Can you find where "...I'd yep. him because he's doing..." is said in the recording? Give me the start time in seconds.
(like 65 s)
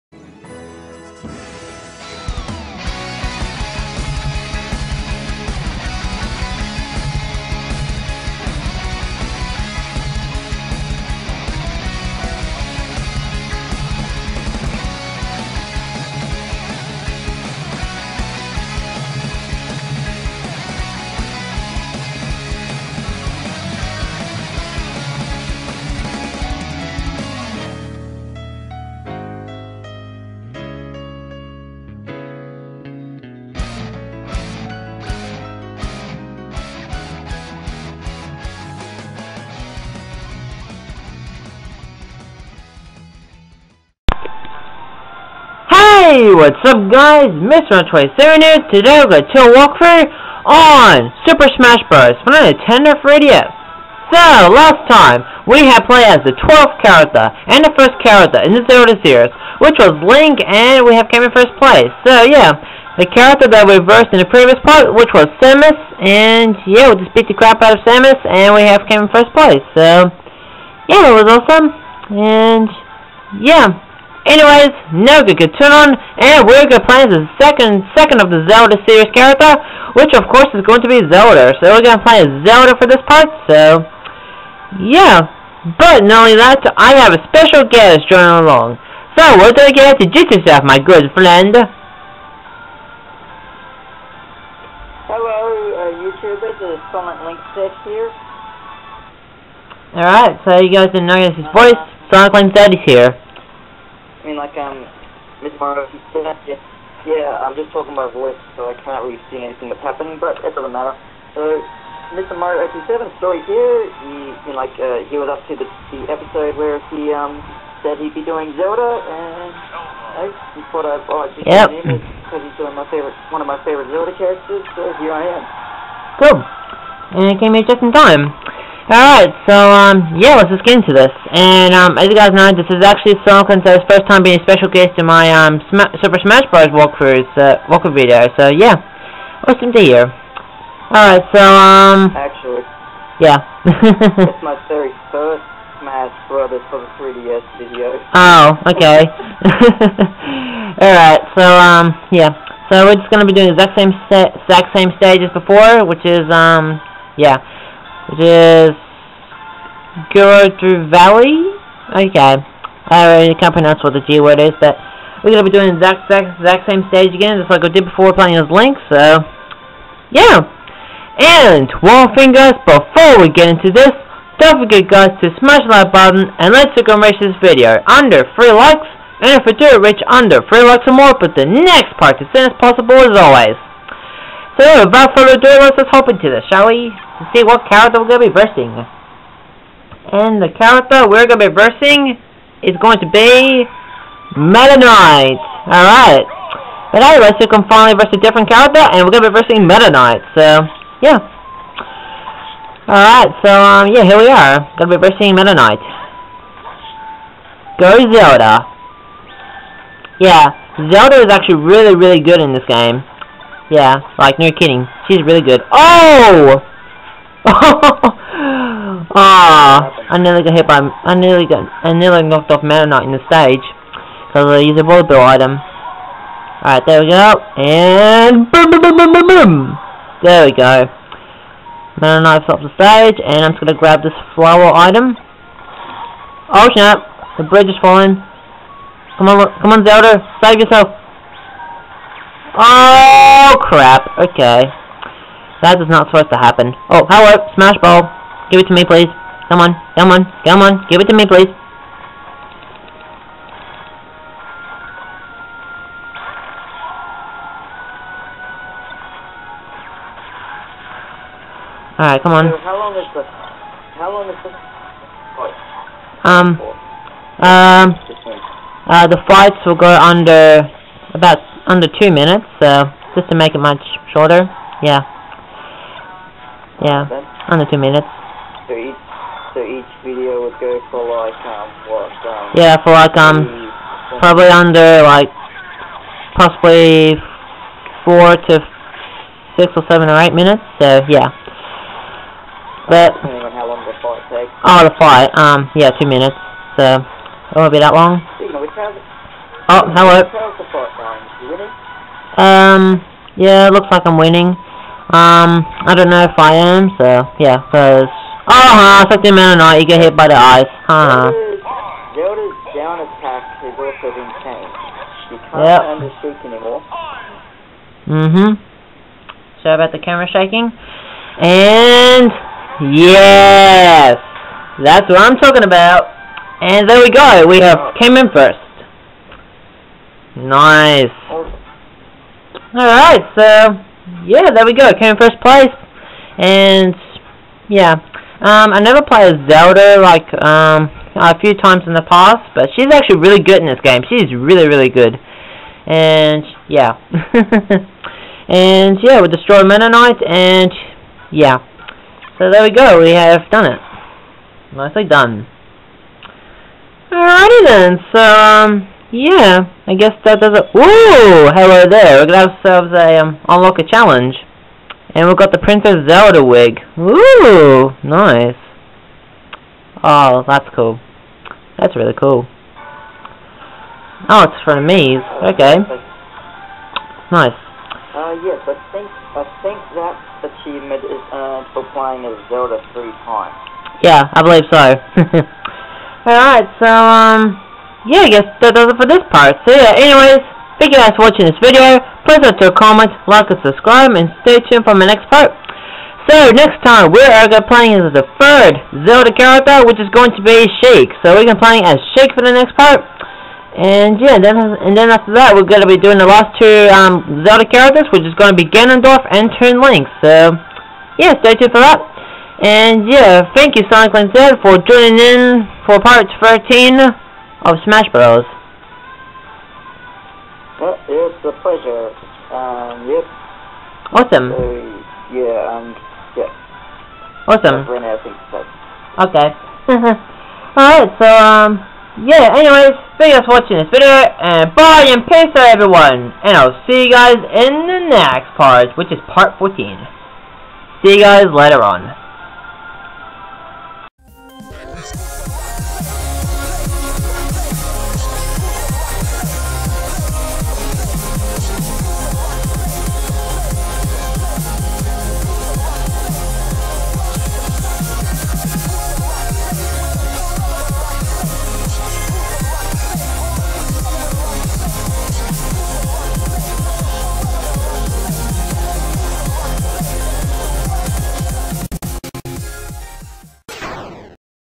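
121 s.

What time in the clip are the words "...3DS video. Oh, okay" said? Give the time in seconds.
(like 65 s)
146 s.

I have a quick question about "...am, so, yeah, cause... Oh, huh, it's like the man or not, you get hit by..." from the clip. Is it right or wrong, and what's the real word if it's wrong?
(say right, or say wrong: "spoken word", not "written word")
right.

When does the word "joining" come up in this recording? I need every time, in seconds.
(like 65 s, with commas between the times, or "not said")
88 s, 414 s.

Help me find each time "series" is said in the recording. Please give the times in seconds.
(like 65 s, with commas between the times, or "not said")
58 s, 78 s.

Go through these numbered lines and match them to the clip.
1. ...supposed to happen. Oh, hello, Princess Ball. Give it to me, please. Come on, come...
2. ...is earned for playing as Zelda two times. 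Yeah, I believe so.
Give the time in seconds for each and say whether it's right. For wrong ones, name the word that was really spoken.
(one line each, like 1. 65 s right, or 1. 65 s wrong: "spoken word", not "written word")
1. 246 s wrong: "Smash", not "Princess"
2. 381 s wrong: "three", not "two".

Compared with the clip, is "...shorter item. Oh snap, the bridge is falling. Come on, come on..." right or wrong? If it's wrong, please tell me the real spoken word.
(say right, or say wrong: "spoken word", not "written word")
wrong: "flower", not "shorter".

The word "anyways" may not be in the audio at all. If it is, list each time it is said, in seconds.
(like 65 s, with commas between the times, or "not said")
74 s, 389 s, 432 s.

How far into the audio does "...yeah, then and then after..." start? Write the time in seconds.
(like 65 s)
404 s.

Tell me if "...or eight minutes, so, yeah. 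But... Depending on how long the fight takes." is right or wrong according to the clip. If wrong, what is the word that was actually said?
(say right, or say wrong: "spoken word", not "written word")
right.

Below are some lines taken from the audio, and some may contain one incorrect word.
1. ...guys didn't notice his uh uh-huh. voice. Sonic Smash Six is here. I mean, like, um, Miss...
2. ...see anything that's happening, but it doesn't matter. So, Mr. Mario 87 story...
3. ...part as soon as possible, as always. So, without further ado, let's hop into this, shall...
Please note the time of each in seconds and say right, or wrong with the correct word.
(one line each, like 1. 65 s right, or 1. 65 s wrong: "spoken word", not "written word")
1. 100 s wrong: "Link", not "Smash"
2. 109 s right
3. 181 s right.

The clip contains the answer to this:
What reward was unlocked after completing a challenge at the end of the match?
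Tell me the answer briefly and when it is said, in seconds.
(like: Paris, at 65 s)
Princess Zelda wig, at 365 s.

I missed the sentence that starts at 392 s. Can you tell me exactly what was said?
Please don't to comment, like, and subscribe, and stay tuned for my next part.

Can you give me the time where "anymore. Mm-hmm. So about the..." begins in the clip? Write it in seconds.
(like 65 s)
316 s.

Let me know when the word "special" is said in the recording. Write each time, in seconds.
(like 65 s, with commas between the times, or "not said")
87 s, 134 s.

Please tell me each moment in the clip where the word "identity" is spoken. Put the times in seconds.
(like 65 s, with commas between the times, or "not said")
not said.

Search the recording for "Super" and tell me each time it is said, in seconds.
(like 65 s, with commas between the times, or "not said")
51 s, 136 s.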